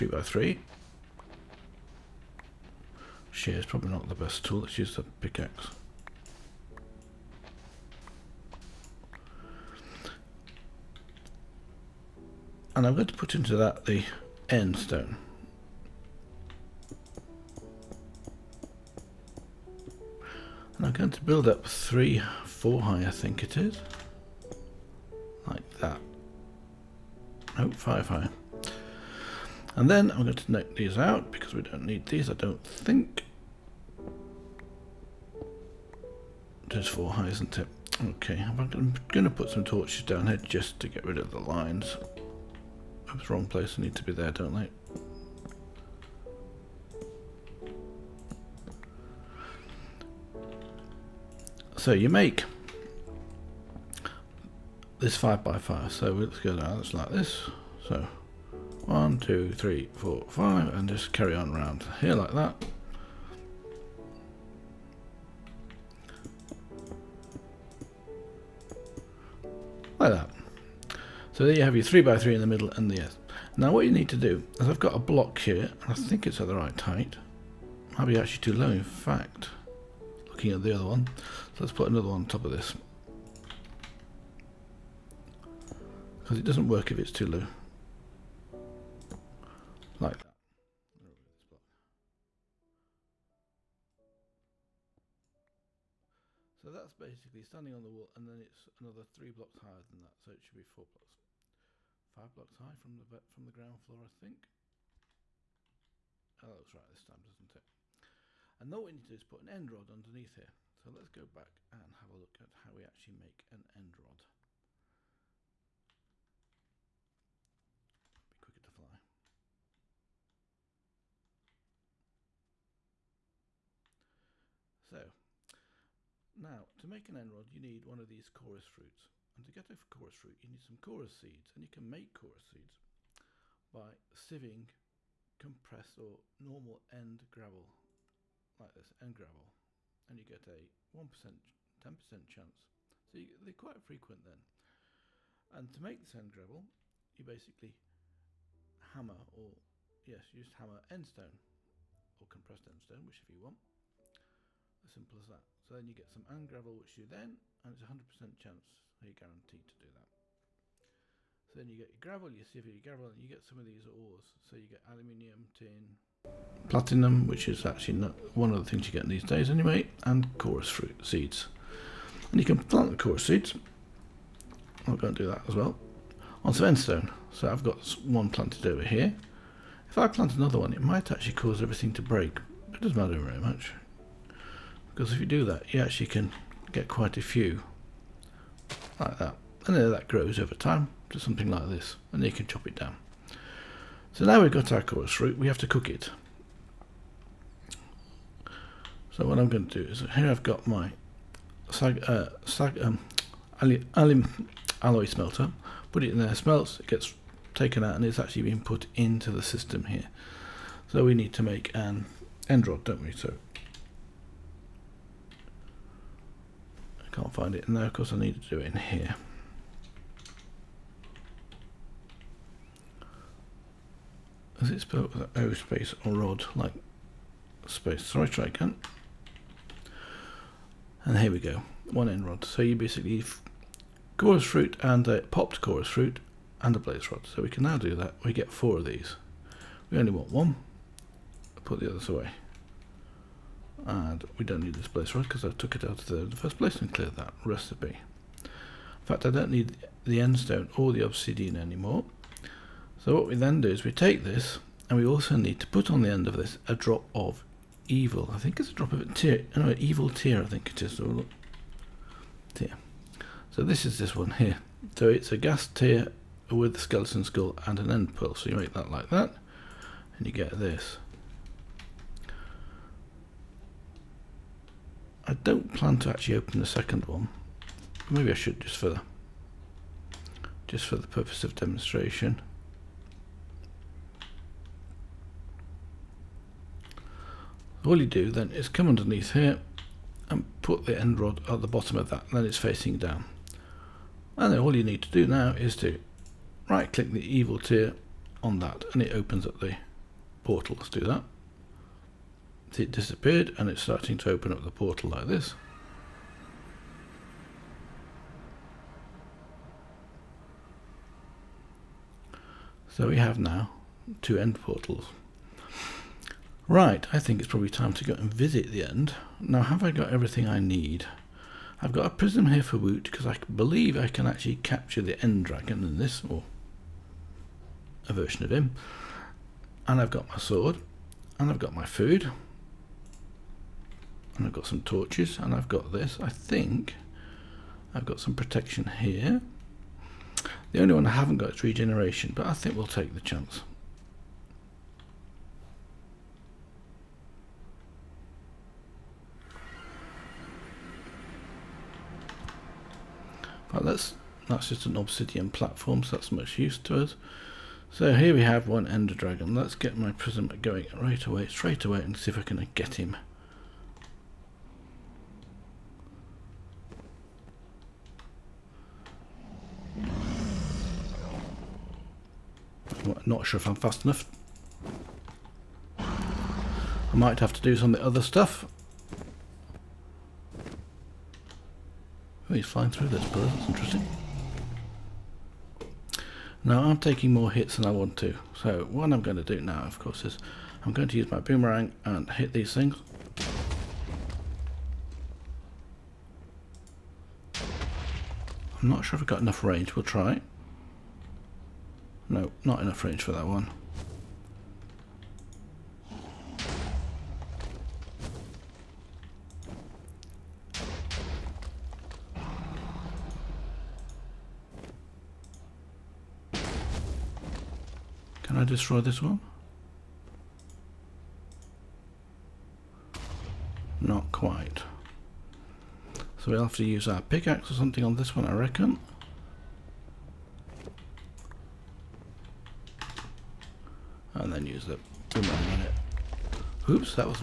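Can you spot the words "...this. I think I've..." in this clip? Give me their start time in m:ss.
5:35.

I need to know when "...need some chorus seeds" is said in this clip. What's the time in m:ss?
2:10.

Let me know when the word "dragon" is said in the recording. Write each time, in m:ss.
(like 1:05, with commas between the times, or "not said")
5:25, 5:59.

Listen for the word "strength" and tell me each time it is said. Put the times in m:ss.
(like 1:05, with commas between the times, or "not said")
not said.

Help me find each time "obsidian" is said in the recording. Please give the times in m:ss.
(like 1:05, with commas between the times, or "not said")
4:11, 5:54.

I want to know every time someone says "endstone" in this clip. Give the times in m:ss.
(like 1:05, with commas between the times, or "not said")
2:56, 4:10.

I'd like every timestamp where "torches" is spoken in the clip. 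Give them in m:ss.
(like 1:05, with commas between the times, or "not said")
0:39, 5:34.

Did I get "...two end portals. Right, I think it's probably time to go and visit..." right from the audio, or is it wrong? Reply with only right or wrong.
right.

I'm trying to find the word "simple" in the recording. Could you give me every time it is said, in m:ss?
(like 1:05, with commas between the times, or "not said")
2:34.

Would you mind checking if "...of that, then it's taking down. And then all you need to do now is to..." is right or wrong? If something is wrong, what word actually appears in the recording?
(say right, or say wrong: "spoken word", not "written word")
wrong: "facing", not "taking".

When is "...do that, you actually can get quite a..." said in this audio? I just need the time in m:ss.
3:05.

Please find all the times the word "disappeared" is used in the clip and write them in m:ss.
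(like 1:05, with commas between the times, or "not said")
5:02.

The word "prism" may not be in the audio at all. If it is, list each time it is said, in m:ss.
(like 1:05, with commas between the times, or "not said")
5:22, 6:00.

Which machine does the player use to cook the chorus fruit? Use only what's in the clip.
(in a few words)
Alloy smelter.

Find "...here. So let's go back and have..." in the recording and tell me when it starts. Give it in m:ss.
1:50.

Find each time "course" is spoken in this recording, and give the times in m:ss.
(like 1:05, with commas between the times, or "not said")
3:37, 6:29.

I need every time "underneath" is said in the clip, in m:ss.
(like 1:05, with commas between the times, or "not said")
1:49, 4:48.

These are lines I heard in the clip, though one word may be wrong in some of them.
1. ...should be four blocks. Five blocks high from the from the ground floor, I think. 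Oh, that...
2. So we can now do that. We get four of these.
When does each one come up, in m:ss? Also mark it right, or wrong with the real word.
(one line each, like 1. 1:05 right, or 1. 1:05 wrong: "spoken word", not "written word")
1. 1:40 right
2. 3:57 right.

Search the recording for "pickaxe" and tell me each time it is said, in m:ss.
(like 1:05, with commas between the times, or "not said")
0:05, 7:07.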